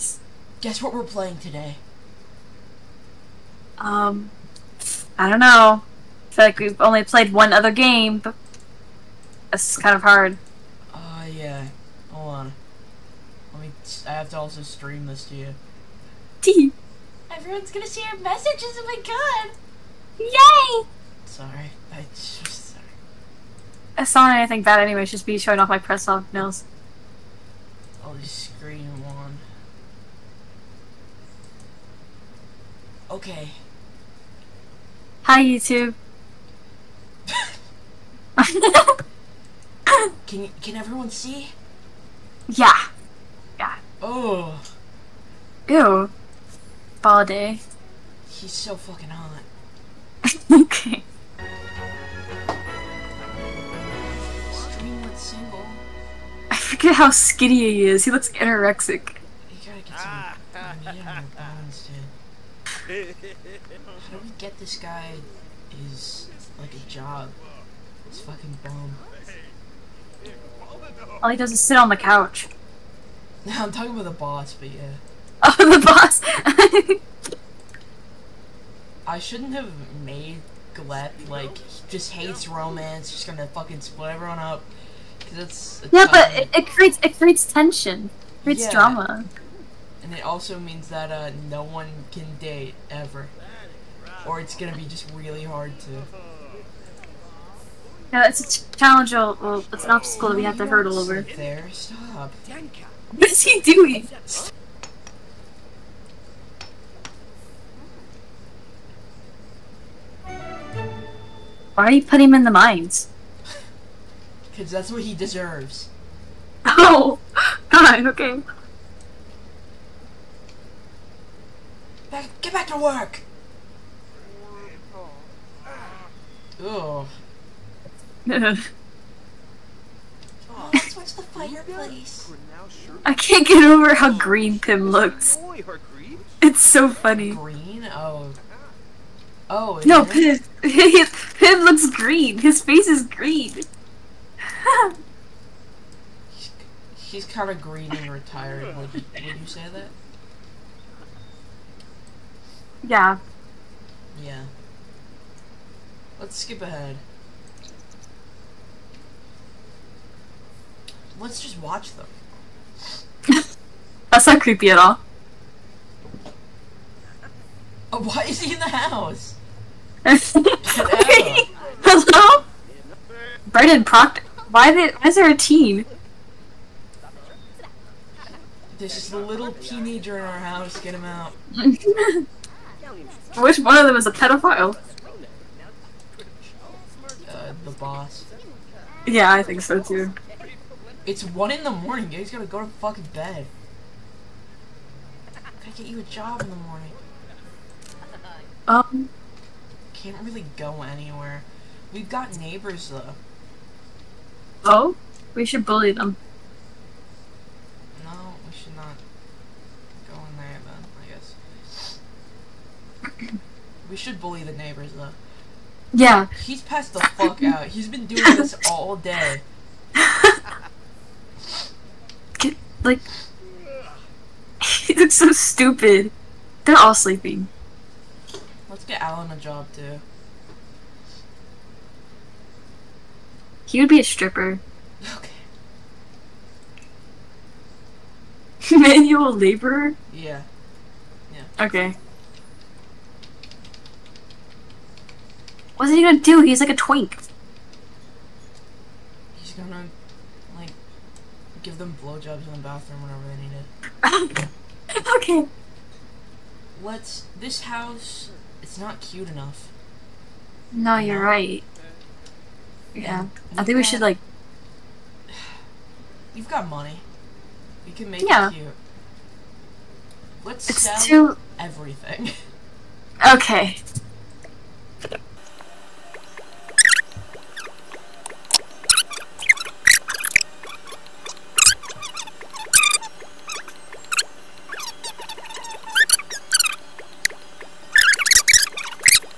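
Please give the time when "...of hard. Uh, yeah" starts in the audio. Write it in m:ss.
0:09.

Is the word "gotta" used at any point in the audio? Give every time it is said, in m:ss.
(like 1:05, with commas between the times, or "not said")
0:59, 3:12.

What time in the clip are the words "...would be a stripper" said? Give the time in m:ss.
3:53.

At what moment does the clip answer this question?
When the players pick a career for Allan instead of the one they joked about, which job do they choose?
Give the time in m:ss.
3:58.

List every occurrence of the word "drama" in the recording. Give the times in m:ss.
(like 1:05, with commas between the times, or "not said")
1:28.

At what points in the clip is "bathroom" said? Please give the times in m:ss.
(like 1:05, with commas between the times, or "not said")
4:12.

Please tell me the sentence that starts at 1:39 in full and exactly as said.
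Well, it's an obstacle that we have to hurdle over.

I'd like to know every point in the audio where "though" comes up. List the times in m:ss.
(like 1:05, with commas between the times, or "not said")
3:22, 3:34.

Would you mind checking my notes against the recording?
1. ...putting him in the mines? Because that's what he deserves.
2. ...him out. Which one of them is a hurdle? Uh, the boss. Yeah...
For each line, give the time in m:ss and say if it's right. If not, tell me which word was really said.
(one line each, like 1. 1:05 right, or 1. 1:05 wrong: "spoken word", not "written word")
1. 1:52 right
2. 3:00 wrong: "pedophile", not "hurdle".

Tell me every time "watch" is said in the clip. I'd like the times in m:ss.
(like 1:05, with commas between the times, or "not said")
2:10, 2:41.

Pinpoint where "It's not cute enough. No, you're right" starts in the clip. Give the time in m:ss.
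4:18.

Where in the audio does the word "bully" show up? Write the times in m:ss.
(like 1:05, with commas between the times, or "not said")
3:25, 3:34.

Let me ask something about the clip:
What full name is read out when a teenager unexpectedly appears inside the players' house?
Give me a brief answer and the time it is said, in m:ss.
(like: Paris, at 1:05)
Brendan Proctor, at 2:53.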